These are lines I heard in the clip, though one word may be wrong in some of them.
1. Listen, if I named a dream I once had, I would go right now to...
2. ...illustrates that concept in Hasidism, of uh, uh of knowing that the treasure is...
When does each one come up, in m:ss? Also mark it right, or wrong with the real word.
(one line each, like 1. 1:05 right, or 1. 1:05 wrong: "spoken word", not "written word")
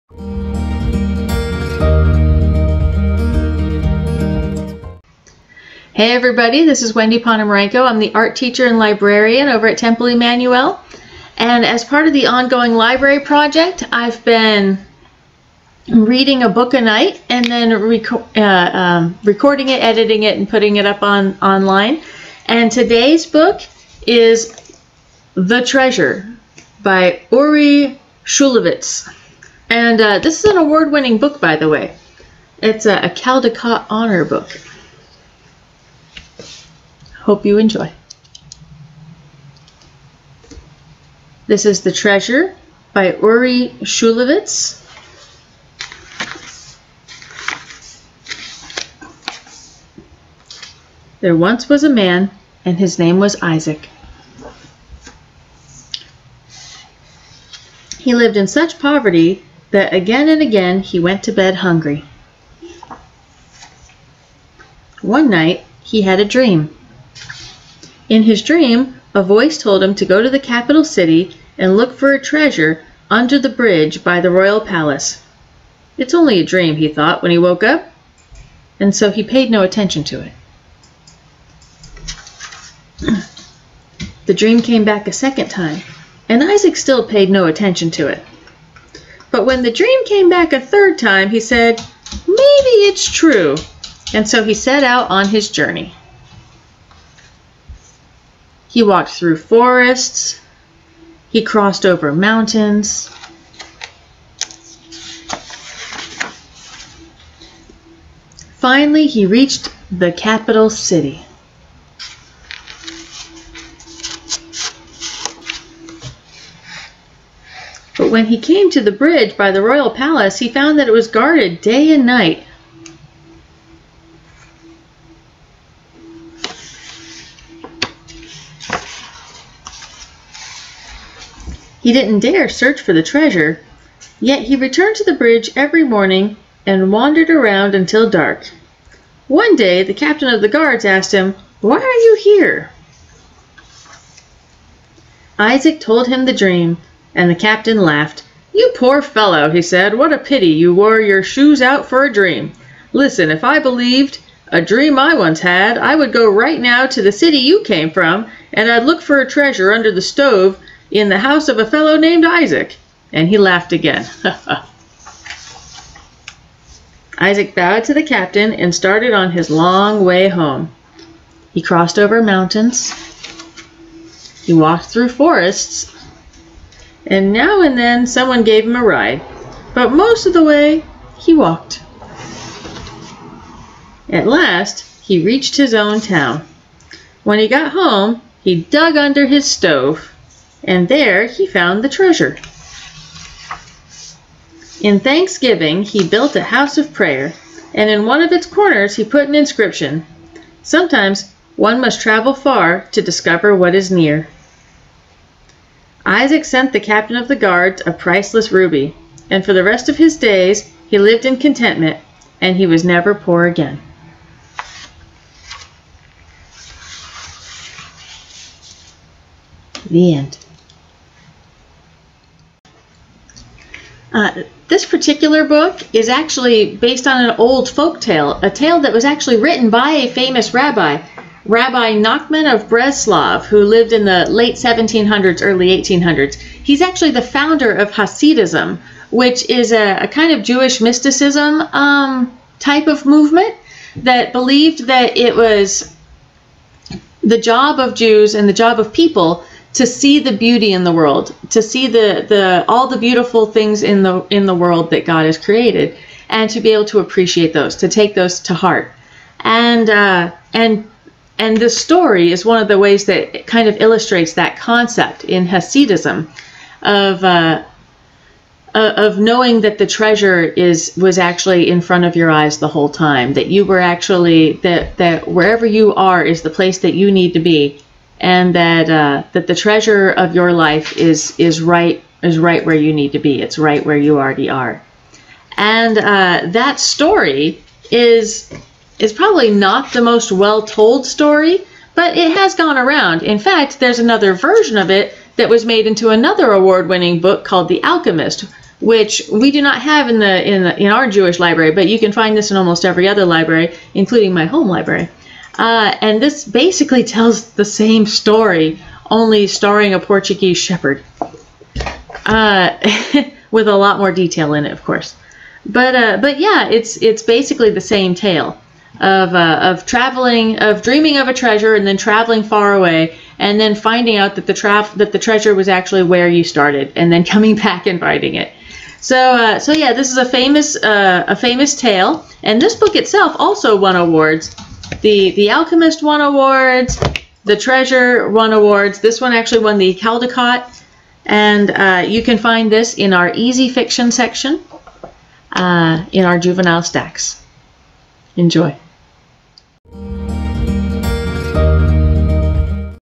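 1. 2:32 wrong: "believed", not "named"
2. 4:23 right.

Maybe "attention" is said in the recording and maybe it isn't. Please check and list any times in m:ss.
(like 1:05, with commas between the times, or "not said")
1:19, 1:27.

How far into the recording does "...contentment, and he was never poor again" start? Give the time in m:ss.
3:31.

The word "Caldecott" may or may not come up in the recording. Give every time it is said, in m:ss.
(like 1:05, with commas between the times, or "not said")
0:33, 5:39.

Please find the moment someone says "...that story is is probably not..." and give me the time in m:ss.
4:46.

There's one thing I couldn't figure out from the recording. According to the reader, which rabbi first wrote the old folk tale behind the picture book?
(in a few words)
Rabbi Nachman of Breslov.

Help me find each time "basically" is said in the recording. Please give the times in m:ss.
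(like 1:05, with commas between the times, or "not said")
5:06, 5:17.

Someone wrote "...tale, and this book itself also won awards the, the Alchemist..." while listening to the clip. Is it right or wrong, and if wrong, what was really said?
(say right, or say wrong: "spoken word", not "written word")
right.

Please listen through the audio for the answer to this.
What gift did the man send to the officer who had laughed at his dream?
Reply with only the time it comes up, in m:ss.
3:27.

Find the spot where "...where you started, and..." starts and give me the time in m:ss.
5:26.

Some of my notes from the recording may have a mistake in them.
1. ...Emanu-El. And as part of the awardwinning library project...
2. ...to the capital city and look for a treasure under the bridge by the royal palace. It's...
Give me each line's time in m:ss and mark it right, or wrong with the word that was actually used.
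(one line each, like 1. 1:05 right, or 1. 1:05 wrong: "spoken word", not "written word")
1. 0:10 wrong: "ongoing", not "awardwinning"
2. 1:10 right.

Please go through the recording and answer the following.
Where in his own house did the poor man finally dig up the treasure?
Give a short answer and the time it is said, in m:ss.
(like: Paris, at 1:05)
Under his stove, at 3:08.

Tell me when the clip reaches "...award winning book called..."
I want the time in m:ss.
4:56.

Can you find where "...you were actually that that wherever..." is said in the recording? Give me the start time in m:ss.
4:33.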